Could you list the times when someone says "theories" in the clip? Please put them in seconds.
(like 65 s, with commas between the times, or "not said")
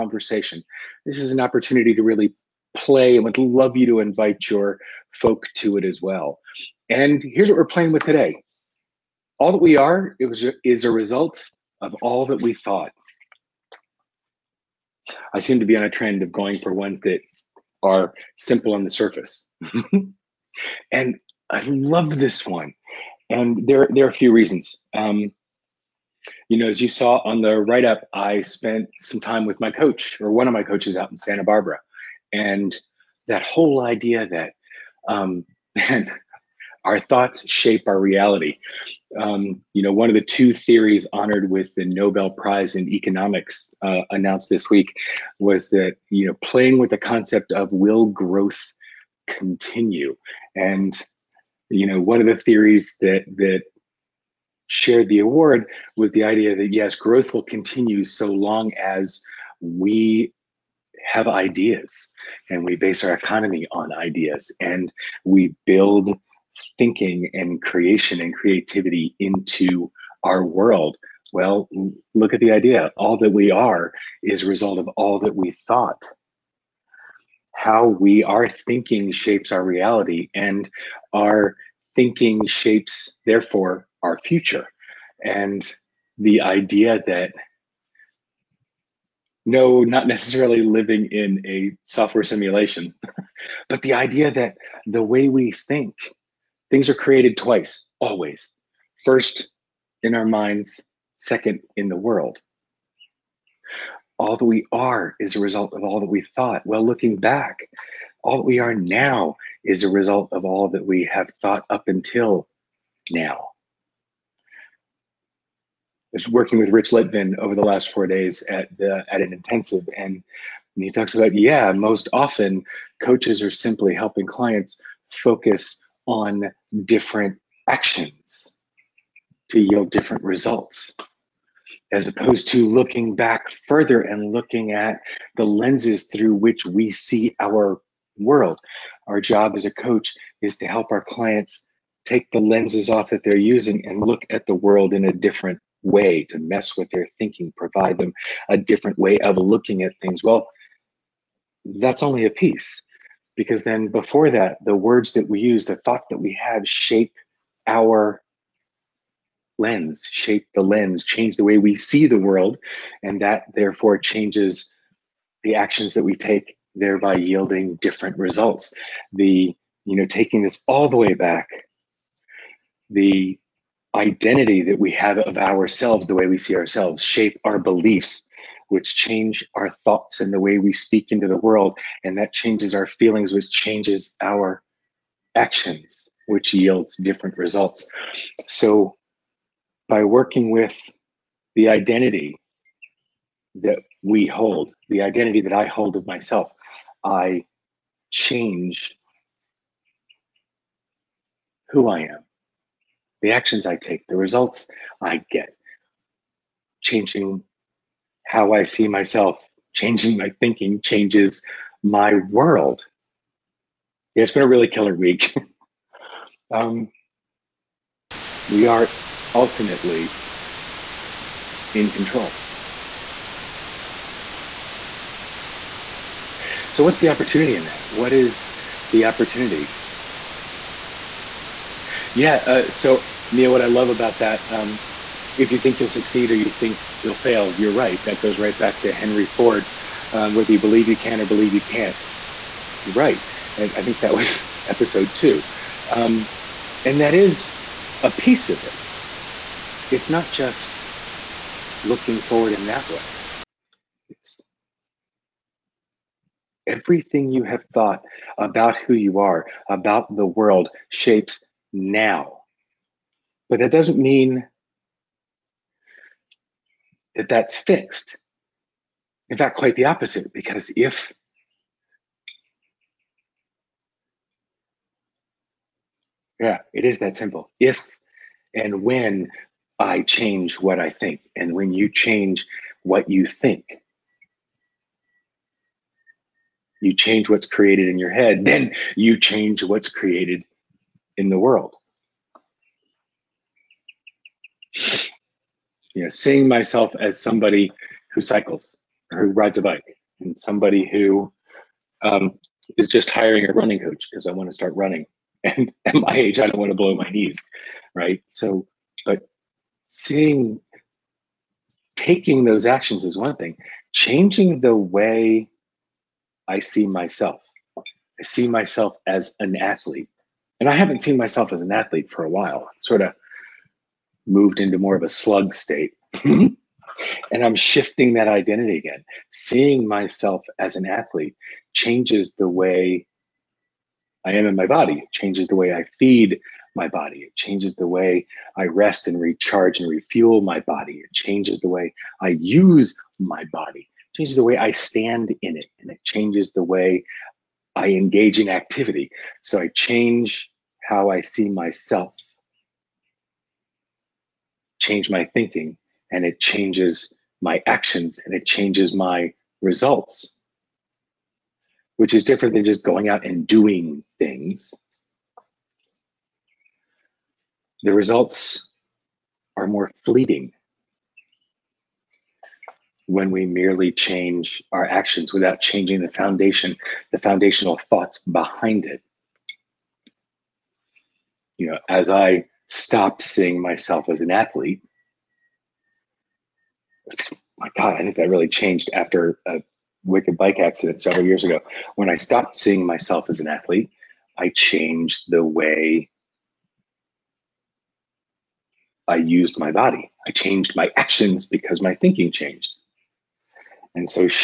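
40 s, 52 s.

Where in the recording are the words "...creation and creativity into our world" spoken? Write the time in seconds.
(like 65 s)
67 s.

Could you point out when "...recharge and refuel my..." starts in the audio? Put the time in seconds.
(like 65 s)
339 s.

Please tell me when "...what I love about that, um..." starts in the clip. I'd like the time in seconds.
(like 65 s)
233 s.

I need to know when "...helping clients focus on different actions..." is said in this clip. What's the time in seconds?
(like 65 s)
123 s.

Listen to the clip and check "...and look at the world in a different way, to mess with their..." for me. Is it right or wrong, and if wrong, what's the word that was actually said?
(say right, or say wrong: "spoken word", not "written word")
right.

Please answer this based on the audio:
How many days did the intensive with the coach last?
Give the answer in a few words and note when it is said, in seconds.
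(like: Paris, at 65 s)
4, at 117 s.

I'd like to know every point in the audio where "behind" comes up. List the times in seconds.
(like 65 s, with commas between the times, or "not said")
378 s.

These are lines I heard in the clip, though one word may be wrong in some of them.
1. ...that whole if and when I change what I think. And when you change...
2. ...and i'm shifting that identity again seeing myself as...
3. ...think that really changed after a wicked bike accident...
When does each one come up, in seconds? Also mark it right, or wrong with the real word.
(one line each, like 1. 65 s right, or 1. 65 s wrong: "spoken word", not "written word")
1. 276 s wrong: "simple", not "whole"
2. 326 s right
3. 387 s right.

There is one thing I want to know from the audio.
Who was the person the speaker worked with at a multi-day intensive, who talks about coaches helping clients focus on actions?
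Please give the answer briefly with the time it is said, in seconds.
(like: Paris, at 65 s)
Rich Litvin, at 116 s.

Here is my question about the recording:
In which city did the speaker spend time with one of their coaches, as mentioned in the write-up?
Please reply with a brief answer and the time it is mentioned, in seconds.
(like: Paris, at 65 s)
Santa Barbara, at 31 s.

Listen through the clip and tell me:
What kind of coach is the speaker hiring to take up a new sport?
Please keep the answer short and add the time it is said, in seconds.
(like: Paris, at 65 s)
running coach, at 303 s.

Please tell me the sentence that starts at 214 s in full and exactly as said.
Yeah, it's been a really killer week.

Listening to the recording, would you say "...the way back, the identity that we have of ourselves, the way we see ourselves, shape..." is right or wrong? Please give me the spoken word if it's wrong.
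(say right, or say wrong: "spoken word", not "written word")
right.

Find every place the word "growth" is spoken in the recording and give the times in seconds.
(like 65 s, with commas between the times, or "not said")
48 s, 56 s.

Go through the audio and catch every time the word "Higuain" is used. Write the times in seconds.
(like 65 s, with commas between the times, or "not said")
not said.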